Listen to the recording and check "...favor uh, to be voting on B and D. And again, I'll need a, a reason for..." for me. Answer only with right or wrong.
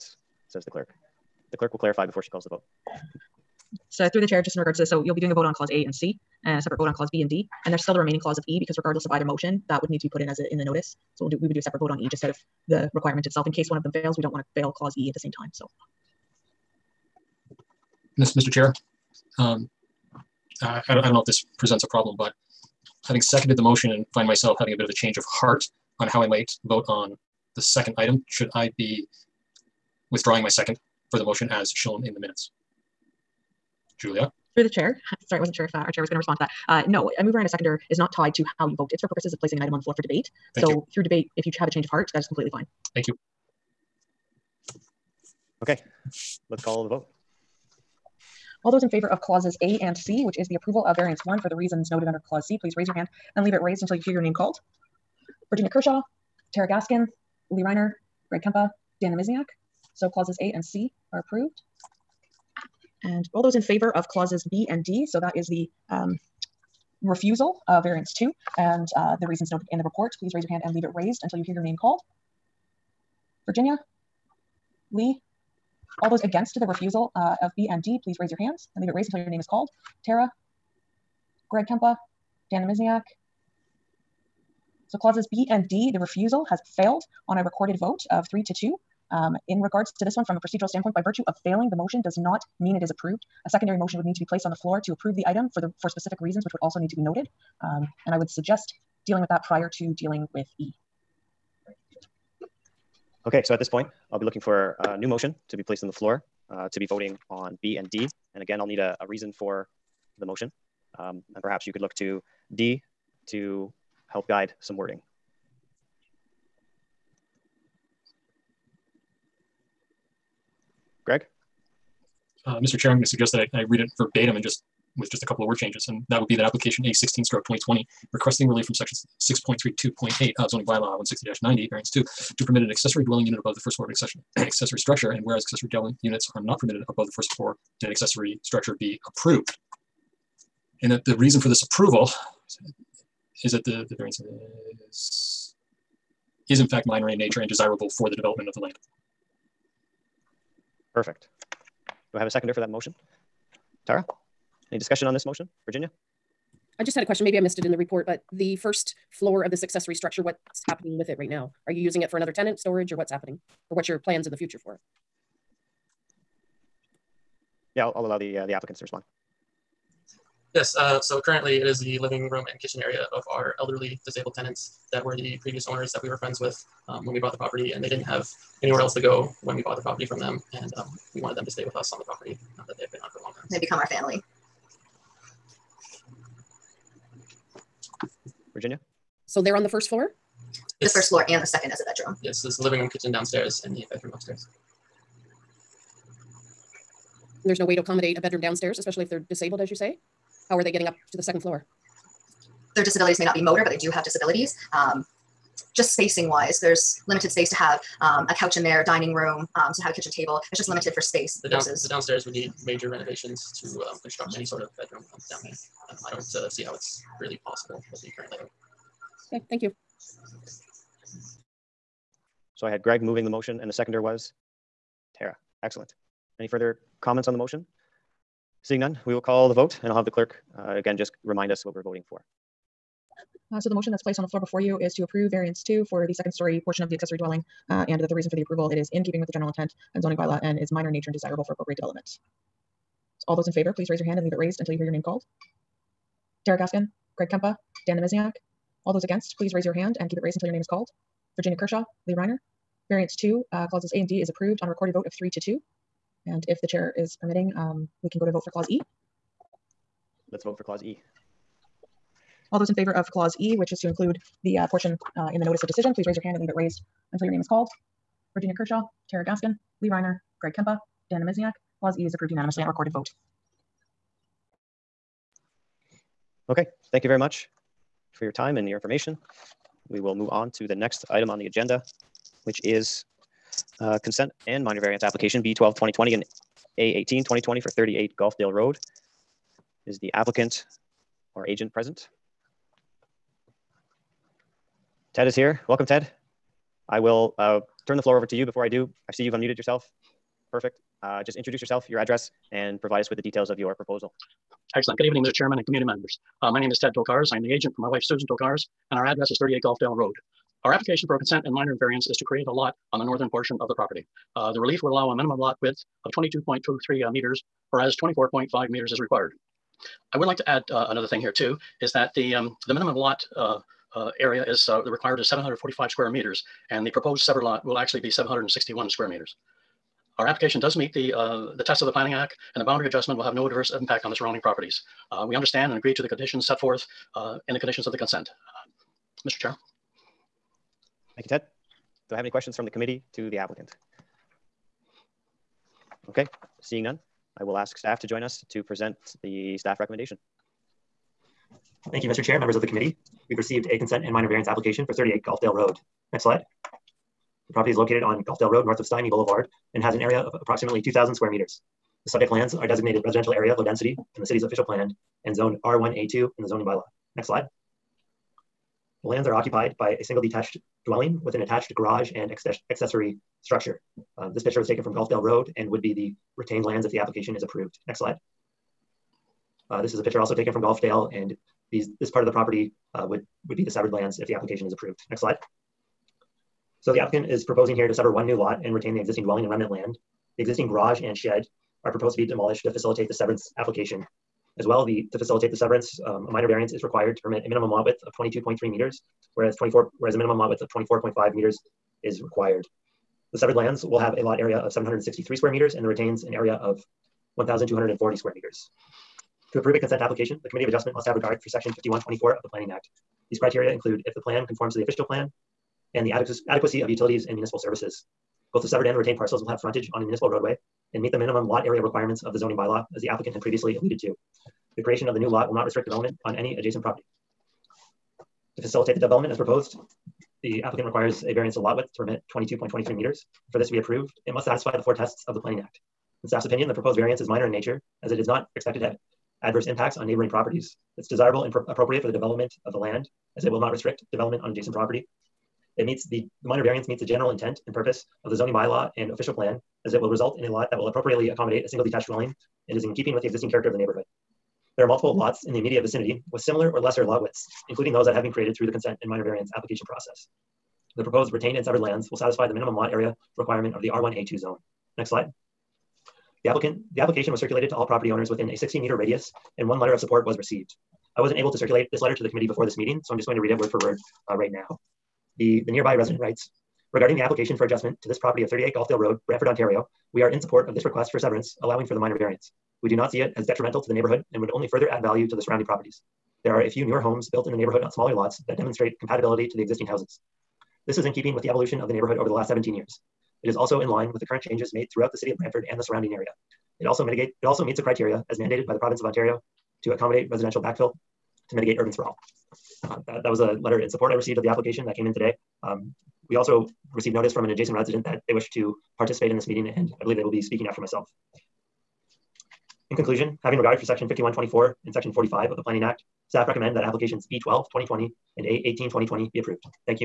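wrong.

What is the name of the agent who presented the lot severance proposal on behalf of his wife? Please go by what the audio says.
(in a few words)
Ted Tokars.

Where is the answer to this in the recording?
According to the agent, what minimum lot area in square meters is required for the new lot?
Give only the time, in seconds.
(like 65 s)
325 s.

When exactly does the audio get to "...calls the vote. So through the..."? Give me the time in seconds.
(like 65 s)
2 s.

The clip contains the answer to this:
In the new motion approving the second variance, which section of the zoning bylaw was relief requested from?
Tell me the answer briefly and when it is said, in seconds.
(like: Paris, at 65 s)
6.32.8, at 129 s.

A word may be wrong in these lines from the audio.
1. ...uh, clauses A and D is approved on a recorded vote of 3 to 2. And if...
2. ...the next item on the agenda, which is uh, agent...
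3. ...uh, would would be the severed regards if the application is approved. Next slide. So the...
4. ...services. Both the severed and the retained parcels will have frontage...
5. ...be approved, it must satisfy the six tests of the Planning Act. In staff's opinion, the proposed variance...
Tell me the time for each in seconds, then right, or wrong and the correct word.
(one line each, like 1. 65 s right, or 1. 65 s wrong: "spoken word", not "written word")
1. 253 s right
2. 280 s wrong: "consent", not "agent"
3. 382 s wrong: "lands", not "regards"
4. 417 s right
5. 433 s wrong: "four", not "six".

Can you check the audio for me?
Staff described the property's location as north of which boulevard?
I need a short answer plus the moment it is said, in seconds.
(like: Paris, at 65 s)
Stymie Boulevard, at 358 s.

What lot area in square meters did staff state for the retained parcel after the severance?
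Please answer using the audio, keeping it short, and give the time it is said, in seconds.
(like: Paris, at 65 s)
1,240, at 407 s.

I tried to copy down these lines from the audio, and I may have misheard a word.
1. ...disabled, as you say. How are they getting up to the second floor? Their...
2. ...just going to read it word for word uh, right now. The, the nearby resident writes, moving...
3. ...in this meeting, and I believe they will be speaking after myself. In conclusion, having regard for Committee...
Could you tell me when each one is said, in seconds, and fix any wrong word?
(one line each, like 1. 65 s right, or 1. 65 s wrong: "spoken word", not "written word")
1. 199 s right
2. 473 s wrong: "regarding", not "moving"
3. 509 s wrong: "Section", not "Committee".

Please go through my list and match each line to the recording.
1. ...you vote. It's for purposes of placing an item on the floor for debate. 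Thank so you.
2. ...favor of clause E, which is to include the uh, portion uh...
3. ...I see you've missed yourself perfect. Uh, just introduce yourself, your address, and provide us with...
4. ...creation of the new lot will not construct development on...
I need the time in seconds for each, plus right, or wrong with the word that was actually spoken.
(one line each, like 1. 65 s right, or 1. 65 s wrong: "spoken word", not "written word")
1. 38 s right
2. 262 s right
3. 299 s wrong: "unmuted", not "missed"
4. 424 s wrong: "restrict", not "construct".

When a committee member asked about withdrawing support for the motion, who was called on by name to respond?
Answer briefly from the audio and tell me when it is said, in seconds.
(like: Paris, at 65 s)
Julia, at 33 s.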